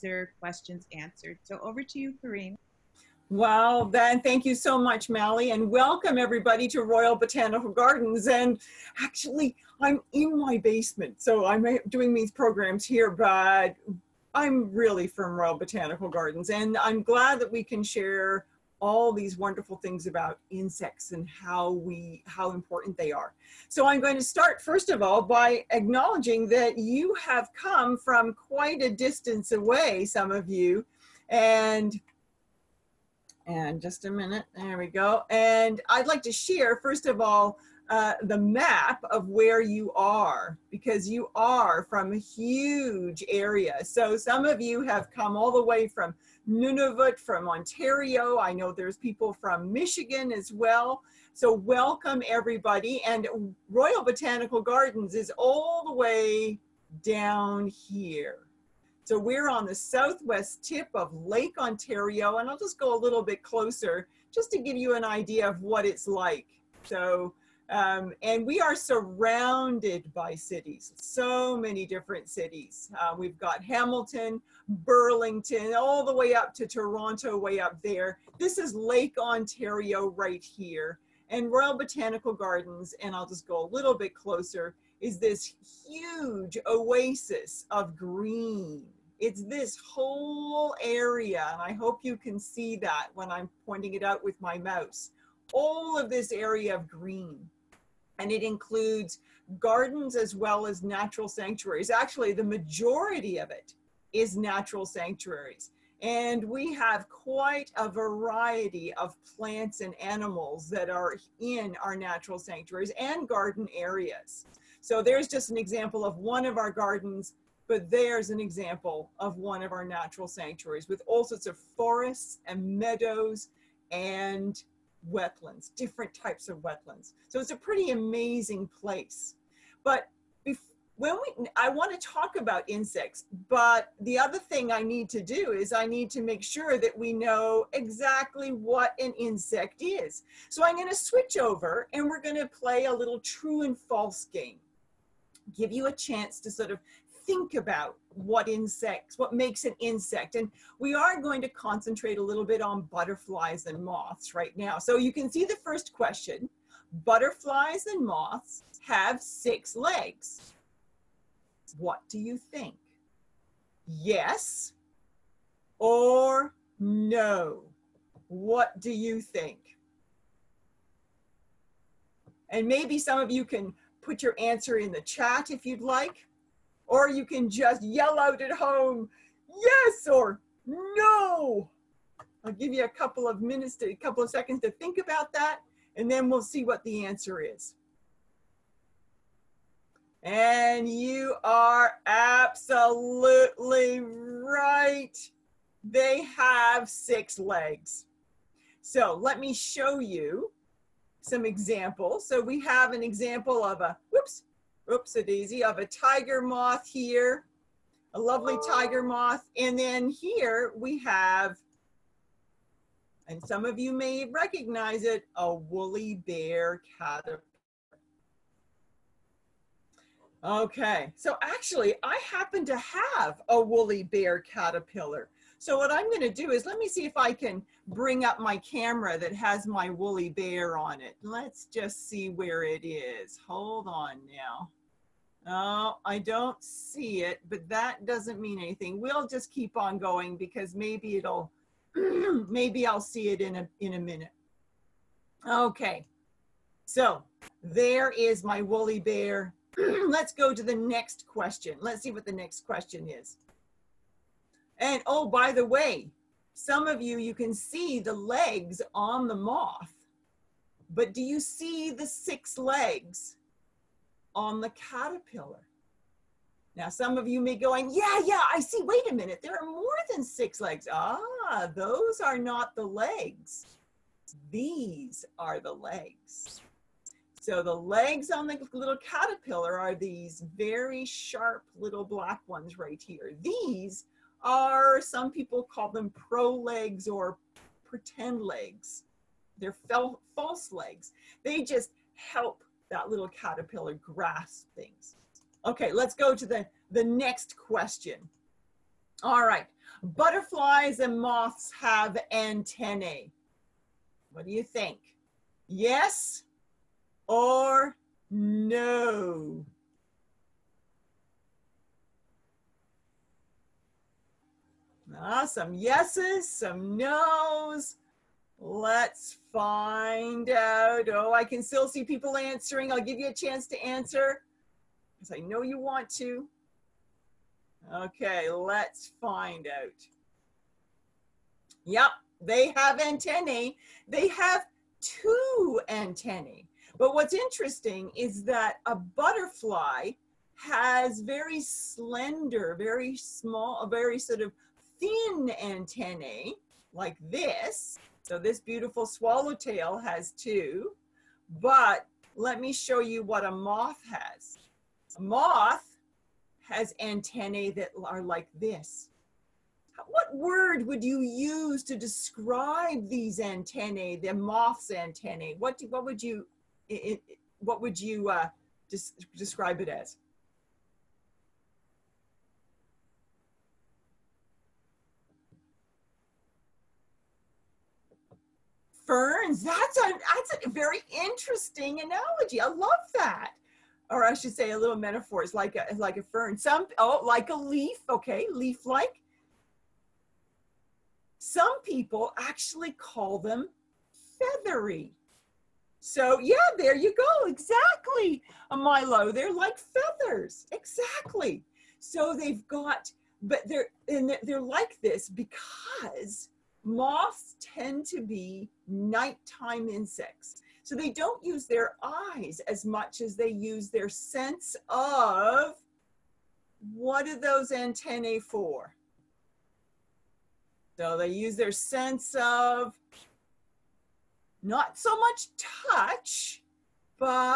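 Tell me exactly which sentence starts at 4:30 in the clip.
Ah, those are not the legs.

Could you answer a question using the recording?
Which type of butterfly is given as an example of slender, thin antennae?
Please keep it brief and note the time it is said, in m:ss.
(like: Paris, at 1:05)
swallowtail, at 5:49.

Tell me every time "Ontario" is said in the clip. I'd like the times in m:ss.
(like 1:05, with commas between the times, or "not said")
0:47, 1:01, 1:19.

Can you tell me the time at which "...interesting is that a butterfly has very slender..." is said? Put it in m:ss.
5:37.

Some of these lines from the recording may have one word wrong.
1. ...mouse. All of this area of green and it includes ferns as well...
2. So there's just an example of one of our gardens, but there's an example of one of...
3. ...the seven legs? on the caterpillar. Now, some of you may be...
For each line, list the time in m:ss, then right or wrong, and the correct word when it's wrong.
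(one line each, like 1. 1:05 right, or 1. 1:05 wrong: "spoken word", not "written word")
1. 1:34 wrong: "gardens", not "ferns"
2. 1:54 right
3. 4:21 wrong: "six", not "seven".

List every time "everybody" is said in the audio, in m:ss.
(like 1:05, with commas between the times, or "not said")
0:06, 0:52.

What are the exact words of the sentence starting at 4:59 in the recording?
All right, butterflies and moths have antennae.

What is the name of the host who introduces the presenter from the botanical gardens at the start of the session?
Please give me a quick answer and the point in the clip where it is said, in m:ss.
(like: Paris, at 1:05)
Mally, at 0:05.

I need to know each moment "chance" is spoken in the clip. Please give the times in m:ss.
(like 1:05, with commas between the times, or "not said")
2:25, 5:23.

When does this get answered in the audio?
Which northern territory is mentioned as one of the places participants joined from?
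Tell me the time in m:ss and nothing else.
0:46.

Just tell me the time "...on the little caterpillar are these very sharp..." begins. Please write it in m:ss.
4:38.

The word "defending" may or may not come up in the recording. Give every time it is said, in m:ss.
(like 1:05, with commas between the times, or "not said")
not said.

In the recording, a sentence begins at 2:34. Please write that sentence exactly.
So you can see the first question.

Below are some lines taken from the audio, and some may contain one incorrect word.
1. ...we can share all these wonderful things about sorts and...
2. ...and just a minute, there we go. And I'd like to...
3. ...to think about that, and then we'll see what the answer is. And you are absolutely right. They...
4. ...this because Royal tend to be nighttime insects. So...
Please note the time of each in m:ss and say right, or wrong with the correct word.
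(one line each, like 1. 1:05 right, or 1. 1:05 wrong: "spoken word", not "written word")
1. 0:17 wrong: "insects", not "sorts"
2. 0:33 right
3. 3:04 right
4. 6:45 wrong: "Moths", not "Royal".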